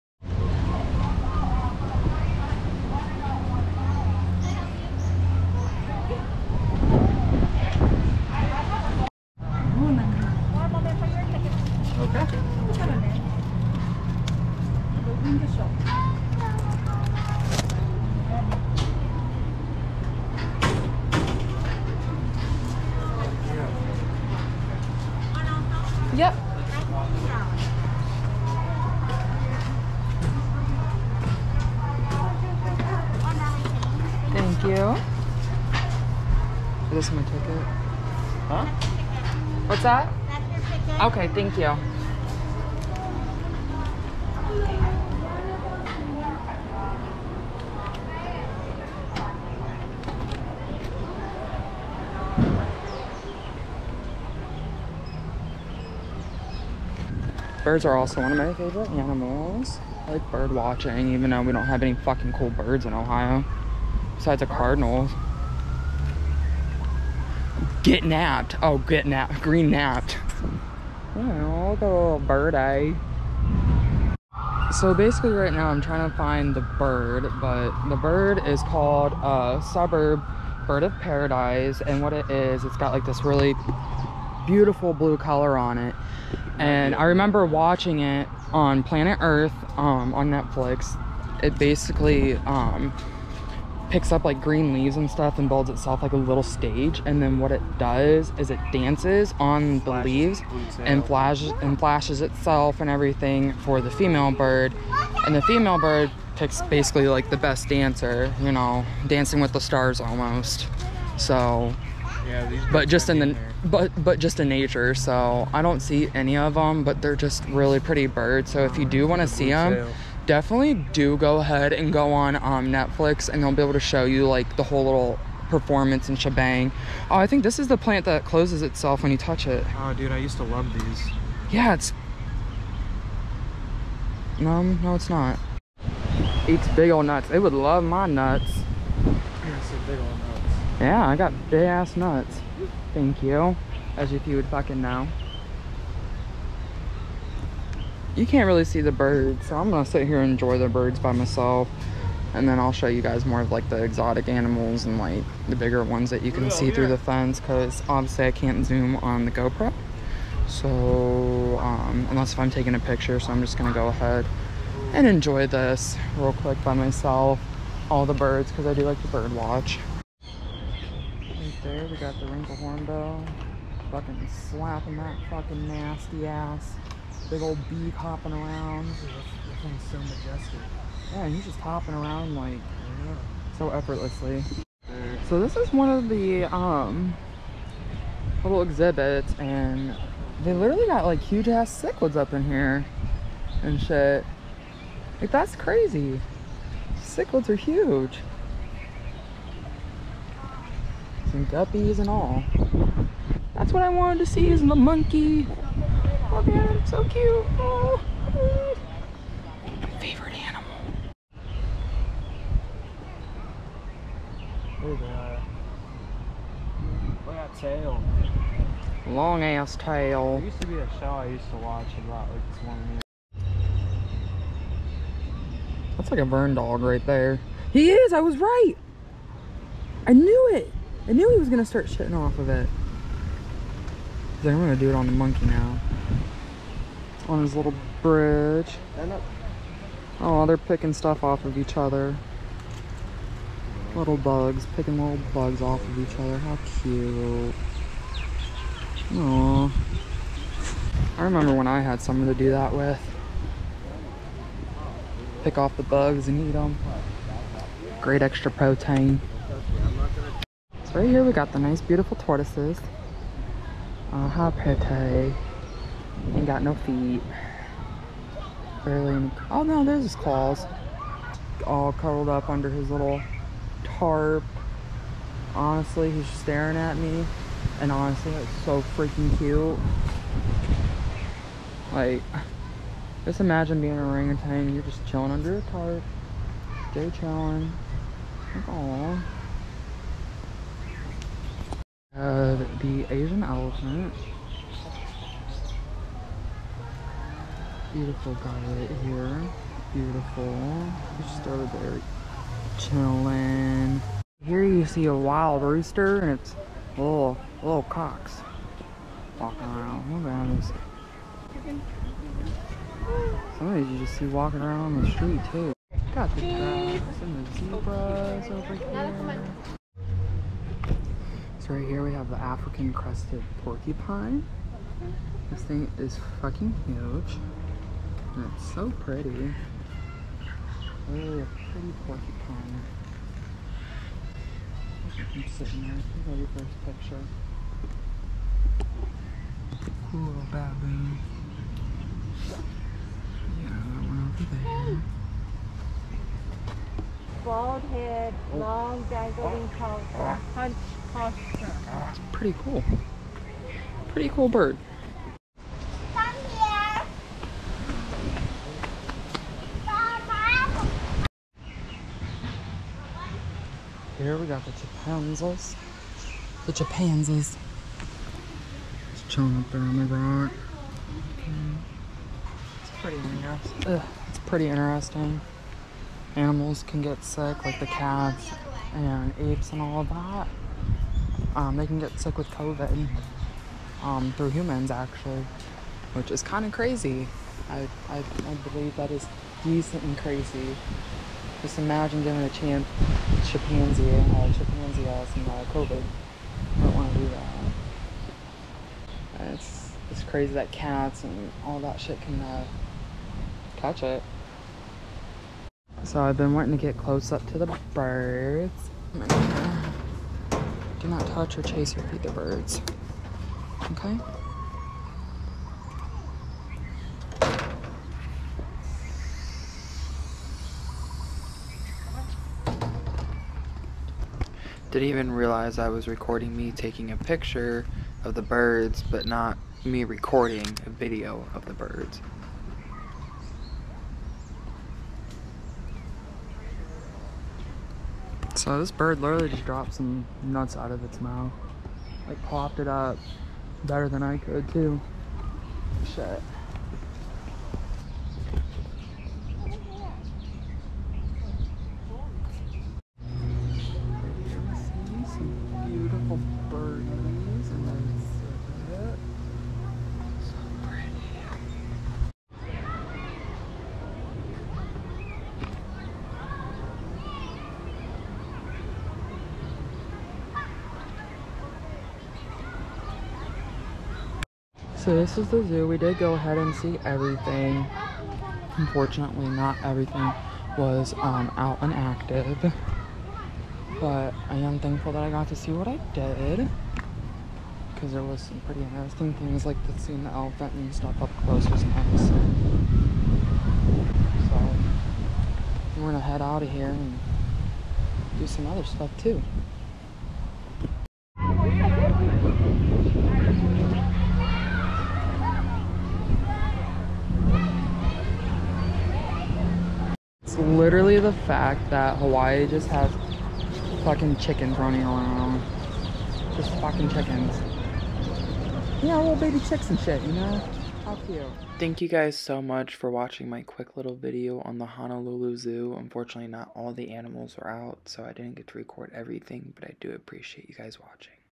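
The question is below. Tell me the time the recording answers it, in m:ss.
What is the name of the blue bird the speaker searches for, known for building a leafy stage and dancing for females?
1:19.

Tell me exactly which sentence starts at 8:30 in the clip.
literally the fact that Hawaii just has fucking chickens running around.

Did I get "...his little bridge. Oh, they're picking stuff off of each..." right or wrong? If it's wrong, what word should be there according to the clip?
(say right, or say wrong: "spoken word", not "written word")
right.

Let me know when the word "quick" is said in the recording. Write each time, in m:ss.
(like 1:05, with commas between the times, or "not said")
2:46, 8:43.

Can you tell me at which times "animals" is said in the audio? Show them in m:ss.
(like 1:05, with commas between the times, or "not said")
0:58, 2:34, 3:30, 6:16, 8:47.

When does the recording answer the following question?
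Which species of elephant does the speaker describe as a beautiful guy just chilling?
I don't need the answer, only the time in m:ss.
4:53.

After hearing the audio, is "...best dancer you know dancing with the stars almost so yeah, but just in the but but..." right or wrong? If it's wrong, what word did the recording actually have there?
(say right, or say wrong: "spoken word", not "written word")
right.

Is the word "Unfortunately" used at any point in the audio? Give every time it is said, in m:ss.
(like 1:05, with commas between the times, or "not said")
7:58, 8:45.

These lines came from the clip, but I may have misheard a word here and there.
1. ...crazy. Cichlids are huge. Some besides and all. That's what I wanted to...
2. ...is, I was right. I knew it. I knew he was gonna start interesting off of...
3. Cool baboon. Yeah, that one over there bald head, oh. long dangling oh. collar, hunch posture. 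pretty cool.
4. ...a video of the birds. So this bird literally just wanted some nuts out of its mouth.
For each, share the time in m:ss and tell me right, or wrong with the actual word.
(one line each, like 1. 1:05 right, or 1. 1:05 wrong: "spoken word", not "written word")
1. 3:15 wrong: "guppies", not "besides"
2. 3:47 wrong: "shitting", not "interesting"
3. 5:40 right
4. 7:10 wrong: "dropped", not "wanted".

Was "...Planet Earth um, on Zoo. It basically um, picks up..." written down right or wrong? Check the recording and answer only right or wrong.
wrong.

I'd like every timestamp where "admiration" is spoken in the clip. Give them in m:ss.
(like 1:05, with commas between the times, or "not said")
not said.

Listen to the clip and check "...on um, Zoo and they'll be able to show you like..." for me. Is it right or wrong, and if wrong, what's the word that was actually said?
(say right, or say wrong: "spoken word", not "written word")
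wrong: "Netflix", not "Zoo".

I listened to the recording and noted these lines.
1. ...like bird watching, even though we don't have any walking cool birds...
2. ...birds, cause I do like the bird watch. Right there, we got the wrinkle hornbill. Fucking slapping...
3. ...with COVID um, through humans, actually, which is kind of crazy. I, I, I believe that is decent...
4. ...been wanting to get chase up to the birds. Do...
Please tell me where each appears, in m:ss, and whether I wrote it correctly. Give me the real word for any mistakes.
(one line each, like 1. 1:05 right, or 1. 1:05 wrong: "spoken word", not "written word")
1. 1:00 wrong: "fucking", not "walking"
2. 2:48 right
3. 6:22 right
4. 6:46 wrong: "close", not "chase".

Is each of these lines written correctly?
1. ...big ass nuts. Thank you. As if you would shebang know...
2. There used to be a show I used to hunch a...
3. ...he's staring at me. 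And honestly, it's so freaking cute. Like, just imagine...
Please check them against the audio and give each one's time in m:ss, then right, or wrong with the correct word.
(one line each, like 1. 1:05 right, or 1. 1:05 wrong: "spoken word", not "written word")
1. 2:21 wrong: "fucking", not "shebang"
2. 3:40 wrong: "watch", not "hunch"
3. 4:36 right.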